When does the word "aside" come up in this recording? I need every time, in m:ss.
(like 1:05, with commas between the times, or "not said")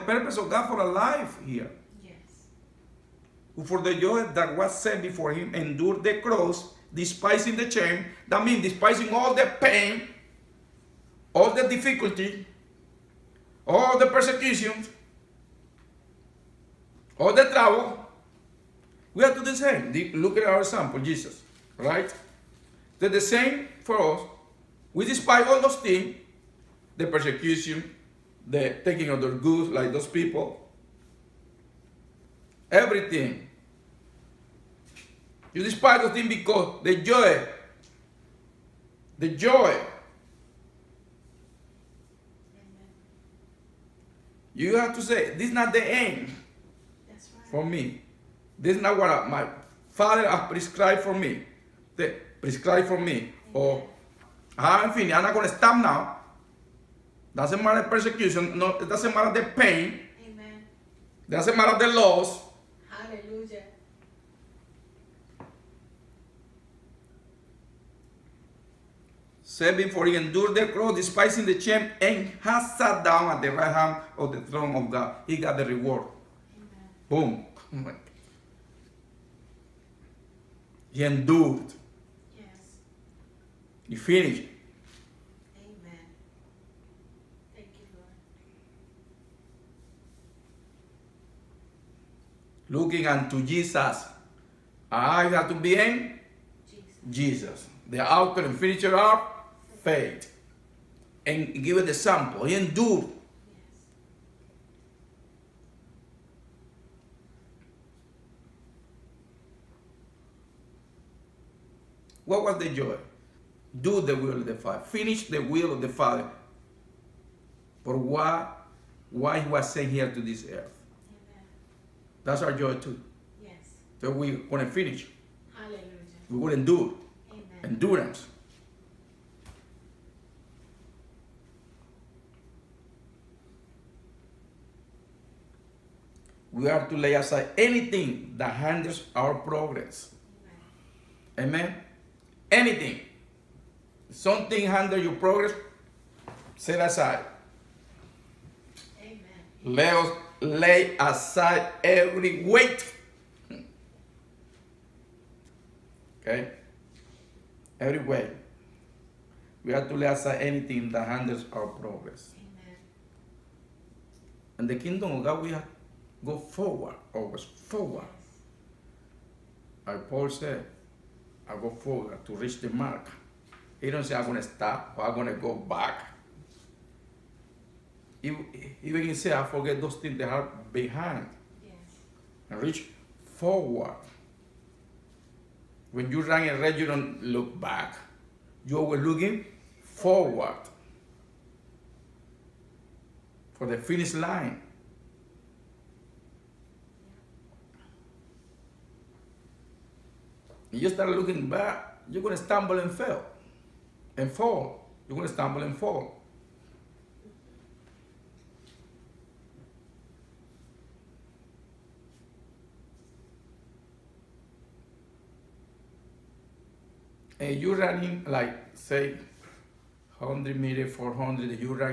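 2:17, 2:26, 2:30, 2:40.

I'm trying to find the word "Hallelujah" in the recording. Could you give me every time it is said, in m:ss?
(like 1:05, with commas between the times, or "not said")
1:02, 2:05.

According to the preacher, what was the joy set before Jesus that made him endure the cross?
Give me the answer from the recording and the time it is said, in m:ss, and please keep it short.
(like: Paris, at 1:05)
Do the will of the Father, at 1:53.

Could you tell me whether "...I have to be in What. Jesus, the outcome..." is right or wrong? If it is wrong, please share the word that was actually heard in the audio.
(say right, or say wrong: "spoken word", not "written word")
wrong: "Jesus", not "What".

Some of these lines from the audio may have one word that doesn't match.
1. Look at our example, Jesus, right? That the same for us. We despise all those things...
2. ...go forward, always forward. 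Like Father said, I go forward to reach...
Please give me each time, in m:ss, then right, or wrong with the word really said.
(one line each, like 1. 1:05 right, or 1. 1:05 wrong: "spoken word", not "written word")
1. 0:20 right
2. 2:46 wrong: "Paul", not "Father".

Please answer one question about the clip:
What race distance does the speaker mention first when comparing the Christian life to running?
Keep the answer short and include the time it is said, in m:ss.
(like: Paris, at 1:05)
100 meter, at 3:40.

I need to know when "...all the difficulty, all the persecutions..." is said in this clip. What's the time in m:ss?
0:11.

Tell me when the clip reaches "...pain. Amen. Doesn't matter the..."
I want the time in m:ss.
0:59.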